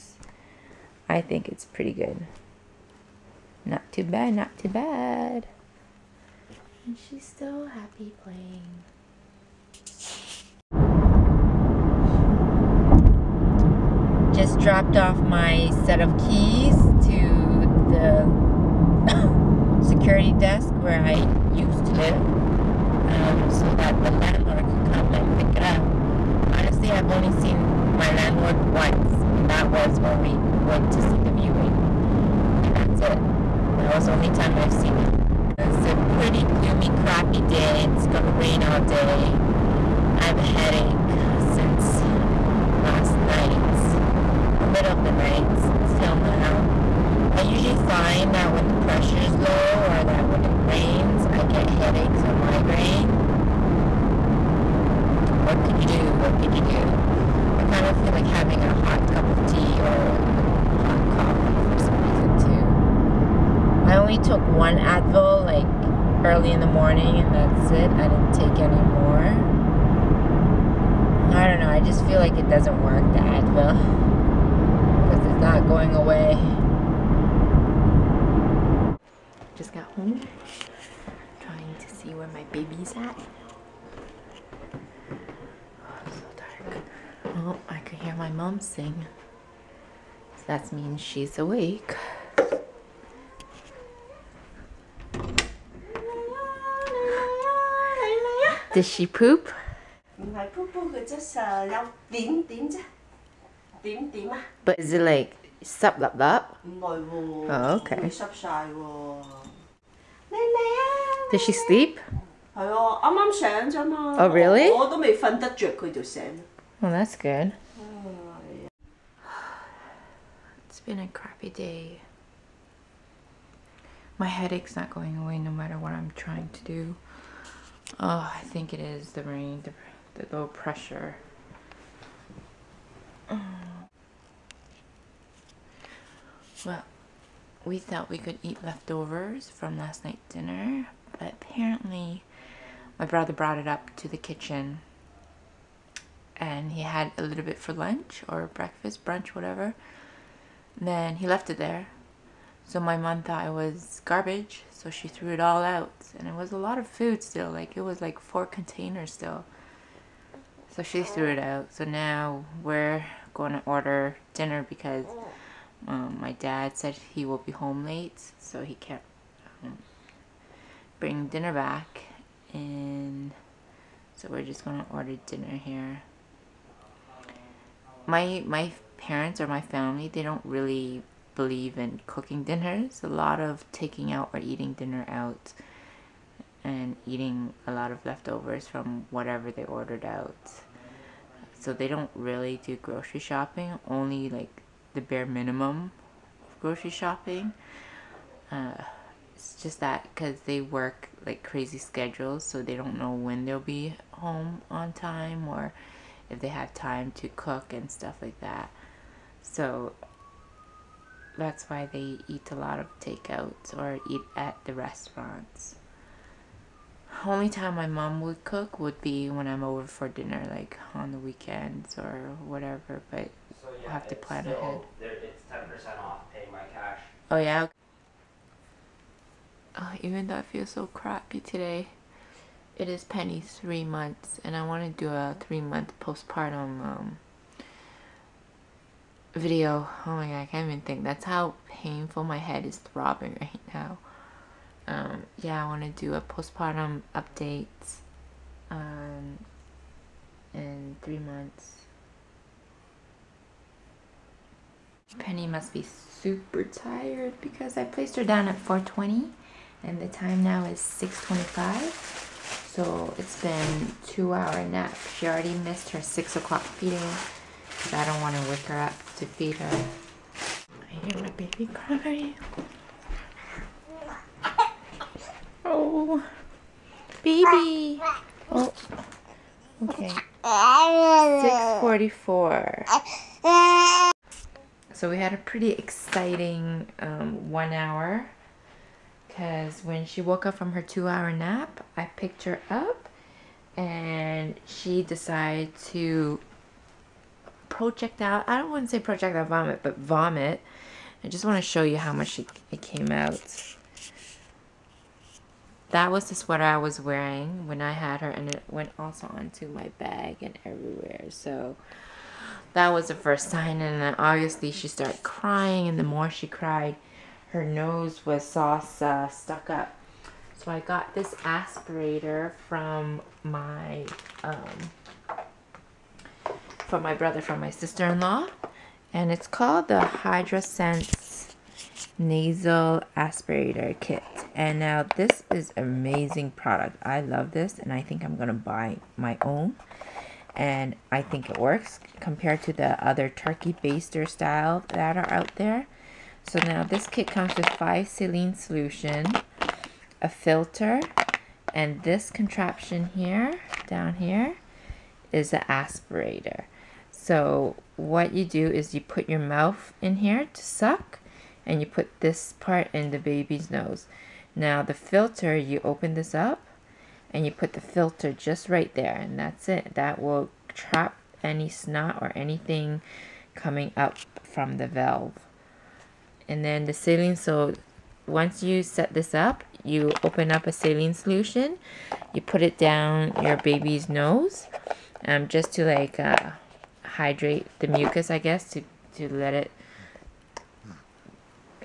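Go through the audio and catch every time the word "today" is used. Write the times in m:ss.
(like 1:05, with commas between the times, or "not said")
3:51.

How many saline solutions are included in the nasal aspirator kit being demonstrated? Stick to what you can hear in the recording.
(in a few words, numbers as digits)
5.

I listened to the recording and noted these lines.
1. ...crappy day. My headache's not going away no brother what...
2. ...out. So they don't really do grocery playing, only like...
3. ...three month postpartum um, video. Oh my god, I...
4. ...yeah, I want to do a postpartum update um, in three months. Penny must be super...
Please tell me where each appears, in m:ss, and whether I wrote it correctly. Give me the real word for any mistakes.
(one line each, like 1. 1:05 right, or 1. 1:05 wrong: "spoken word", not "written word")
1. 2:01 wrong: "matter", not "brother"
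2. 3:10 wrong: "shopping", not "playing"
3. 3:55 right
4. 4:05 right.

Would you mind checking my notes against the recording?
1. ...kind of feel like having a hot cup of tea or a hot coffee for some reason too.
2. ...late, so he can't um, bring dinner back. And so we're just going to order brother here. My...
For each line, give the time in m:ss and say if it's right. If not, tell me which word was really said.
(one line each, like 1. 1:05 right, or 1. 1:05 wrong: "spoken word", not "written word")
1. 0:57 right
2. 2:47 wrong: "dinner", not "brother".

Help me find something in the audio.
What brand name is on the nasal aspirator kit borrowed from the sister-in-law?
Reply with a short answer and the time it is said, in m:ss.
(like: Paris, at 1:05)
HydraSense, at 5:30.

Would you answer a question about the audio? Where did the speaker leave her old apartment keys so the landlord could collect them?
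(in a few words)
Security desk.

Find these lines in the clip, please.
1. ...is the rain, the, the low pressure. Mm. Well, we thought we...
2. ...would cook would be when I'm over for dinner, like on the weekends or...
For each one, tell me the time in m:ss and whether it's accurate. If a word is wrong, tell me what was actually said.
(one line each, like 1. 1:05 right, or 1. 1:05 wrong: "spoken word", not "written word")
1. 2:08 right
2. 3:38 right.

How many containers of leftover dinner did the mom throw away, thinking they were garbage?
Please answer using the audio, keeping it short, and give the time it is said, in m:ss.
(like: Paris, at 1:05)
4, at 2:38.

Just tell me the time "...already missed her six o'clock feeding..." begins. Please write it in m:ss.
4:25.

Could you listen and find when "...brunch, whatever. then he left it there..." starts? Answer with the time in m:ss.
2:29.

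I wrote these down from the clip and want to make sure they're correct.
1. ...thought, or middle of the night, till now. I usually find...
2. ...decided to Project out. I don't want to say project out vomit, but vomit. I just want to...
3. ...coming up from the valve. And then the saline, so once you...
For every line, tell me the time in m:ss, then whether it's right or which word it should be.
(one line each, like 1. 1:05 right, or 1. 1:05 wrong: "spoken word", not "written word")
1. 0:43 wrong: "night", not "thought"
2. 4:55 right
3. 6:13 right.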